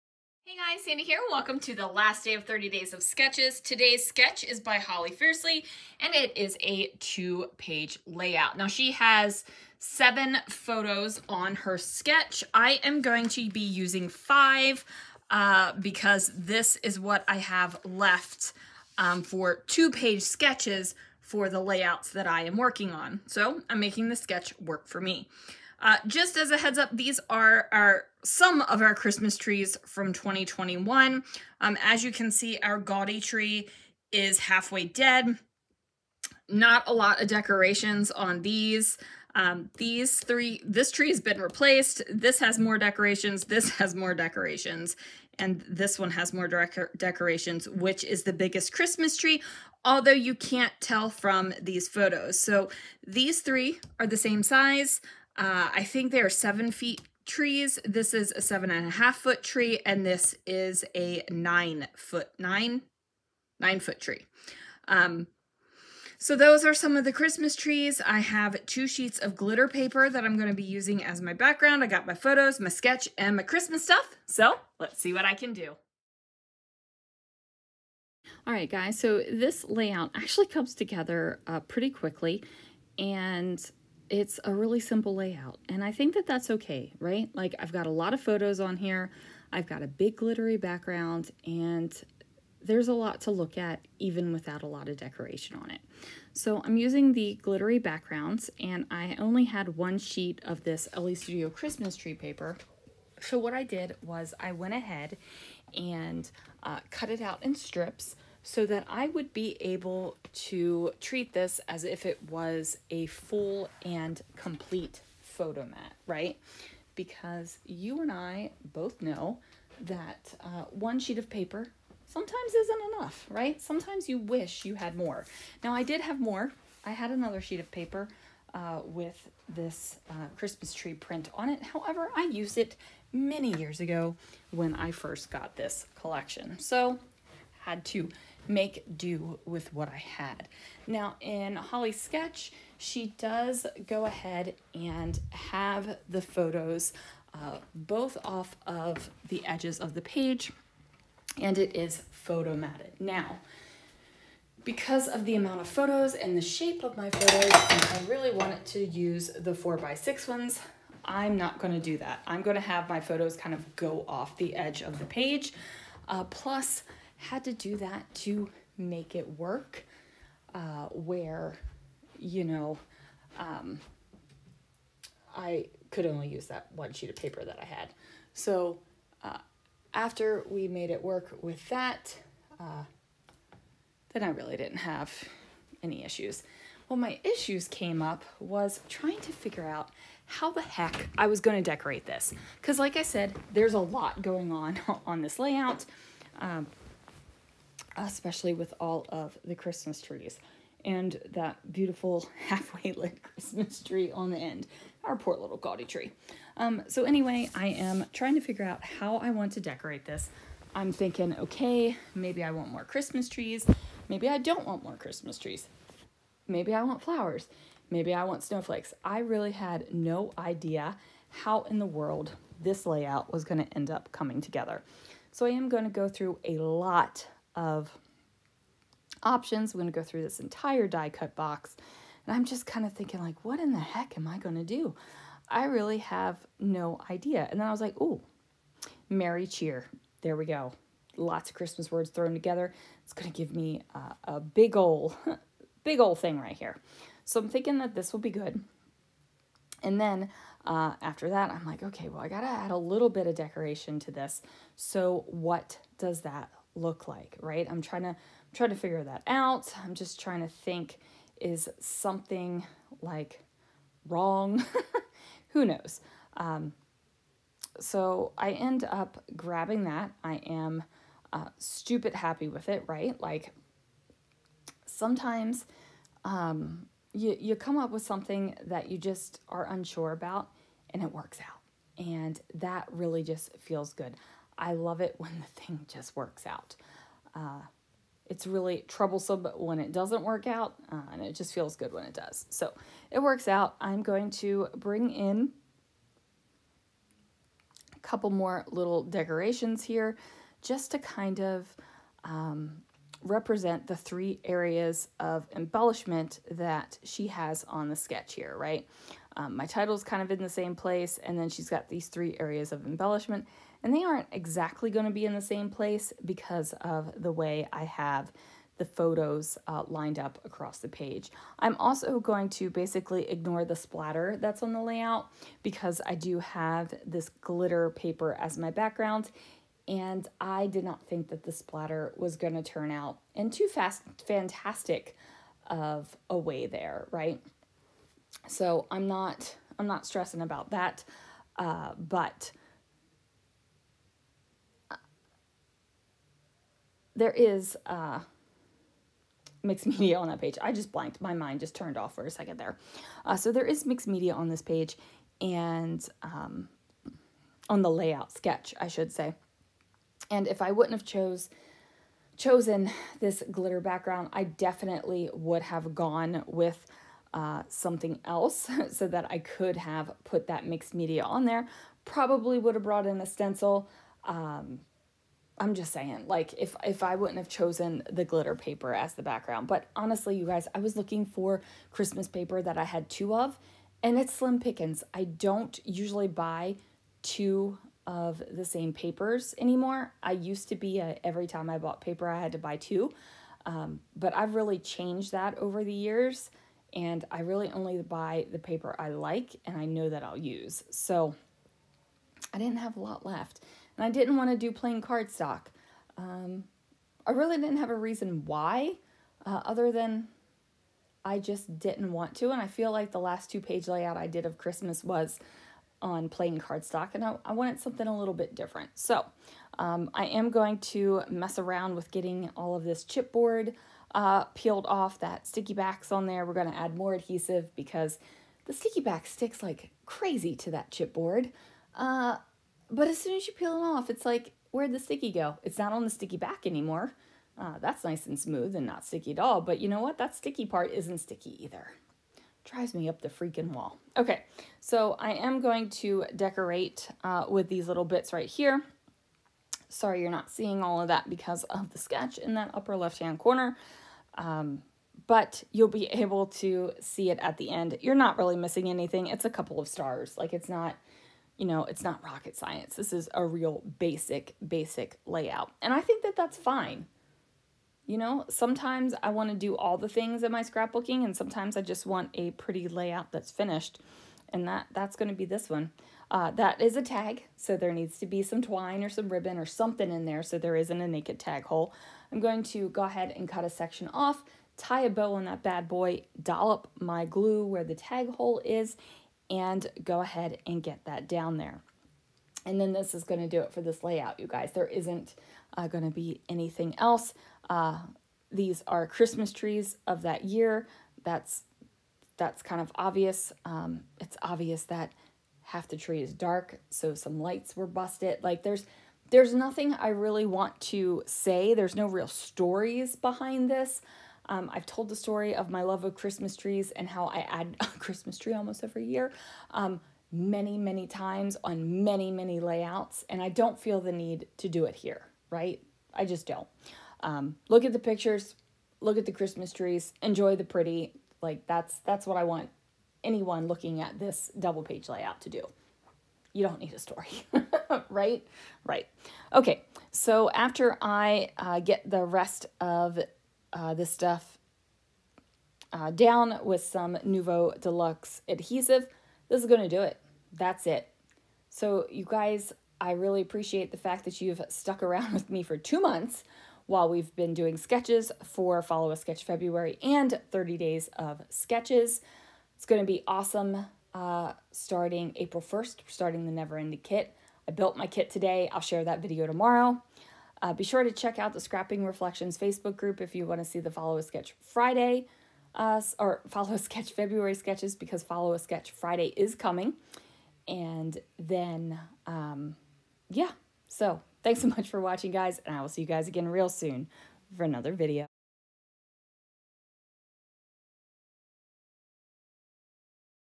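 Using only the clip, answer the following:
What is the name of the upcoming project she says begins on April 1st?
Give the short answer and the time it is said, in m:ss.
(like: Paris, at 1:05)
Never Ending Kit, at 9:26.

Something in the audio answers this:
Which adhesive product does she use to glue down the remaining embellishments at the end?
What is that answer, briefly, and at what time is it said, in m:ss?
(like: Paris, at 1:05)
Nuvo Deluxe, at 9:07.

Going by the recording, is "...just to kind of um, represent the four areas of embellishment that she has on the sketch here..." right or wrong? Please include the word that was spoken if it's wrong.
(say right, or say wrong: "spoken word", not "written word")
wrong: "three", not "four".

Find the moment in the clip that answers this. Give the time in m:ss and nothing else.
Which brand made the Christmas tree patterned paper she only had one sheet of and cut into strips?
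1:40.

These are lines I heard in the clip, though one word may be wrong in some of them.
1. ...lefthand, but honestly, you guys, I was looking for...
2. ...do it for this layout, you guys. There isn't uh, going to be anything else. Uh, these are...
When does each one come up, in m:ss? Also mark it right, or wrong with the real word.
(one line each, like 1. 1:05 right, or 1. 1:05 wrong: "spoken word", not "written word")
1. 6:19 wrong: "background", not "lefthand"
2. 8:13 right.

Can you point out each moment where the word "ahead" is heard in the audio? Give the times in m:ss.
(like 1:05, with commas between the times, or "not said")
1:44, 2:24, 8:03, 8:10.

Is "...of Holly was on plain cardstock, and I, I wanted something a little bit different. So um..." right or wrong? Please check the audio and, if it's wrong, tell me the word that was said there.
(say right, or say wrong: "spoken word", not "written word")
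wrong: "Christmas", not "Holly".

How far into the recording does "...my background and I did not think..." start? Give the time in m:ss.
5:28.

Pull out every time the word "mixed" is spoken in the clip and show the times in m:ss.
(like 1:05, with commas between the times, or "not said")
5:49, 5:53, 6:10.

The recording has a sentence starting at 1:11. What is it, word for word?
I got my photos, my sketch, and my Christmas stuff.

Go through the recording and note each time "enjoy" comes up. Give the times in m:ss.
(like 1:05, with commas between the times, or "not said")
8:50.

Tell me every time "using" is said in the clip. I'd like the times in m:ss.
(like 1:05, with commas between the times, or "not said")
0:13, 1:10, 1:36.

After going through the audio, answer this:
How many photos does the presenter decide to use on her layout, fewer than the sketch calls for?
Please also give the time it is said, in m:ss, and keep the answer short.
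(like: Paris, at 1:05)
5, at 0:14.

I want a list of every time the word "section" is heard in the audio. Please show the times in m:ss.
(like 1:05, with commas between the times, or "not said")
8:03.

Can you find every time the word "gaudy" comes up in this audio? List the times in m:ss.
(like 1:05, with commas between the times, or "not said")
0:32, 3:25.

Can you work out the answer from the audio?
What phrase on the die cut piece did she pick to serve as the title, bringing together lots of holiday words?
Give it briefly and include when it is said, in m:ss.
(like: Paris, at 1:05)
Merry Cheer, at 3:59.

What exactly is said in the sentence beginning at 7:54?
And that that's going to be this one.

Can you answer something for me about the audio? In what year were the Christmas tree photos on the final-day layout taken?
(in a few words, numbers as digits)
2021.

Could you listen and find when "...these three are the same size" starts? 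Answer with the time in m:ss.
0:53.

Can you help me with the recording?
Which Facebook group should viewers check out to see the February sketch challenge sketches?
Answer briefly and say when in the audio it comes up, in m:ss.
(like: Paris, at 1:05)
Scrapping Reflections, at 9:31.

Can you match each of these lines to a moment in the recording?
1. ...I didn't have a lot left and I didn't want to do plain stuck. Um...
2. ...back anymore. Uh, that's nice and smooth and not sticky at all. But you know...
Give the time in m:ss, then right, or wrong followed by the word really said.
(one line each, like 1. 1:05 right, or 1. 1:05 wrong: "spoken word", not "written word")
1. 6:42 wrong: "cardstock", not "stuck"
2. 7:16 right.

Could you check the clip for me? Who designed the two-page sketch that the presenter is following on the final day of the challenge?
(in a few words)
Holly Fiercely.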